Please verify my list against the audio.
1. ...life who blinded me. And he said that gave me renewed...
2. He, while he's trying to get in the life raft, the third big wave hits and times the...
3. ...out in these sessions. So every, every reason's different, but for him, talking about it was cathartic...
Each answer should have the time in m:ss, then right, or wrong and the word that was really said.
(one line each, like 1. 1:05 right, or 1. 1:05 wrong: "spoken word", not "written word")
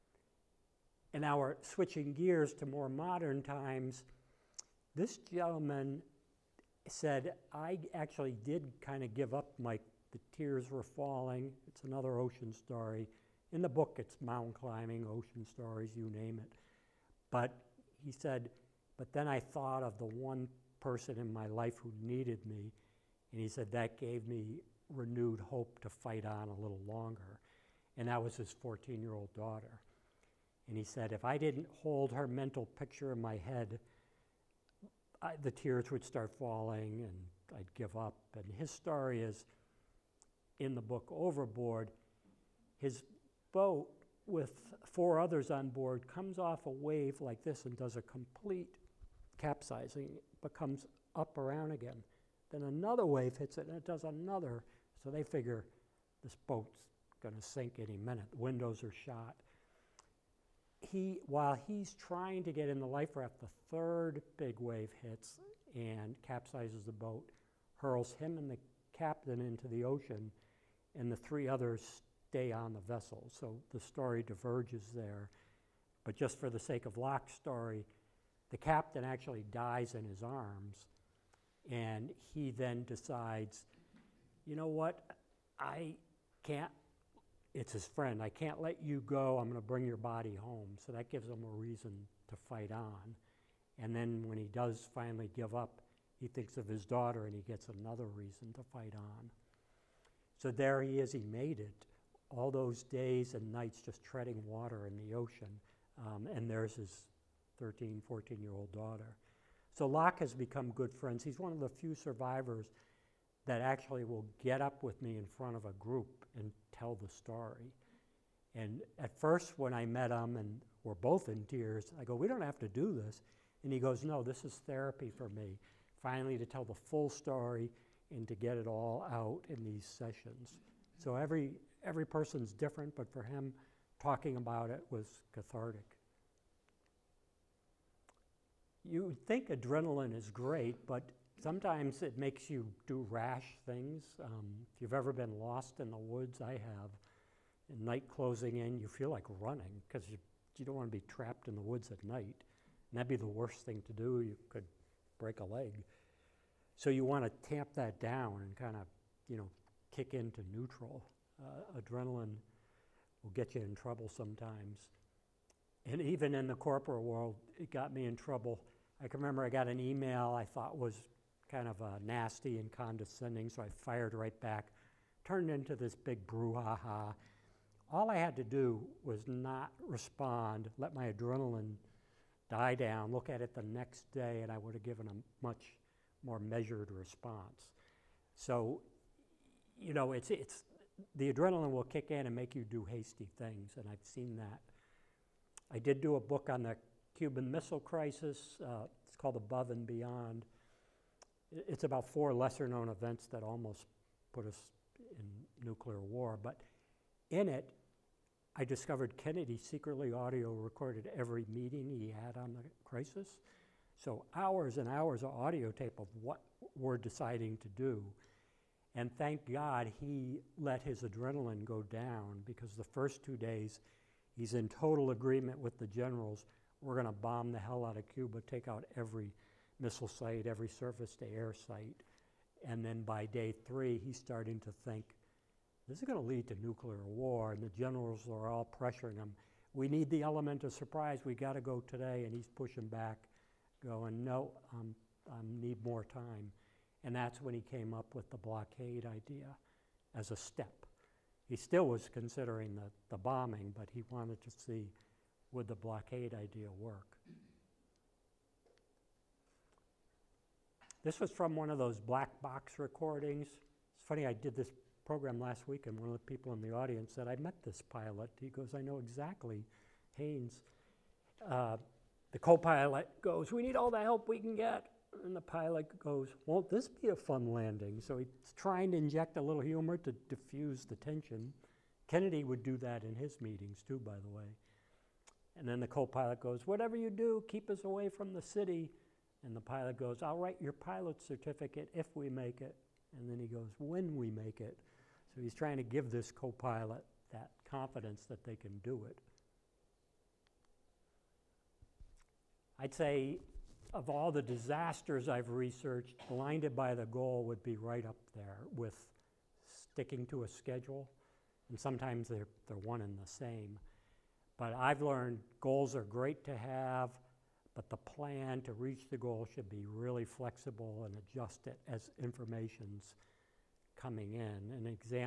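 1. 0:21 wrong: "needed", not "blinded"
2. 1:00 wrong: "capsizes", not "times"
3. 2:09 wrong: "person", not "reason".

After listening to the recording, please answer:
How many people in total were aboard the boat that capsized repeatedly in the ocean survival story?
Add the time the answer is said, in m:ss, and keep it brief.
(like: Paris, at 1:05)
5, at 0:44.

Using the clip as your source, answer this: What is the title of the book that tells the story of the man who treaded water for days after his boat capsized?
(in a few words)
Overboard.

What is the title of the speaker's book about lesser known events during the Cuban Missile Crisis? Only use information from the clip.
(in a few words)
Above and Beyond.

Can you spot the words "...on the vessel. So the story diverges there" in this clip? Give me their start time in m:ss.
1:12.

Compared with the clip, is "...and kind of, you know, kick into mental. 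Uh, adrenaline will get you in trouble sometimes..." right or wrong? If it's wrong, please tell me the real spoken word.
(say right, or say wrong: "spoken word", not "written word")
wrong: "neutral", not "mental".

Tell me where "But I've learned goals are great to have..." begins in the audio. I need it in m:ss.
5:14.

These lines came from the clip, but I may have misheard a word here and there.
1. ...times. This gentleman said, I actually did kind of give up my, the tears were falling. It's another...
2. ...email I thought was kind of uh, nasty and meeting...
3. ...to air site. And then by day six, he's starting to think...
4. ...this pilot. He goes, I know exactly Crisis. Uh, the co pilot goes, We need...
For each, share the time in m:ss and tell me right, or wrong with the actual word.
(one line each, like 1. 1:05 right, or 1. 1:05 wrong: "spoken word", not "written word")
1. 0:03 right
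2. 2:49 wrong: "condescending", not "meeting"
3. 3:51 wrong: "three", not "six"
4. 4:27 wrong: "Haynes", not "Crisis".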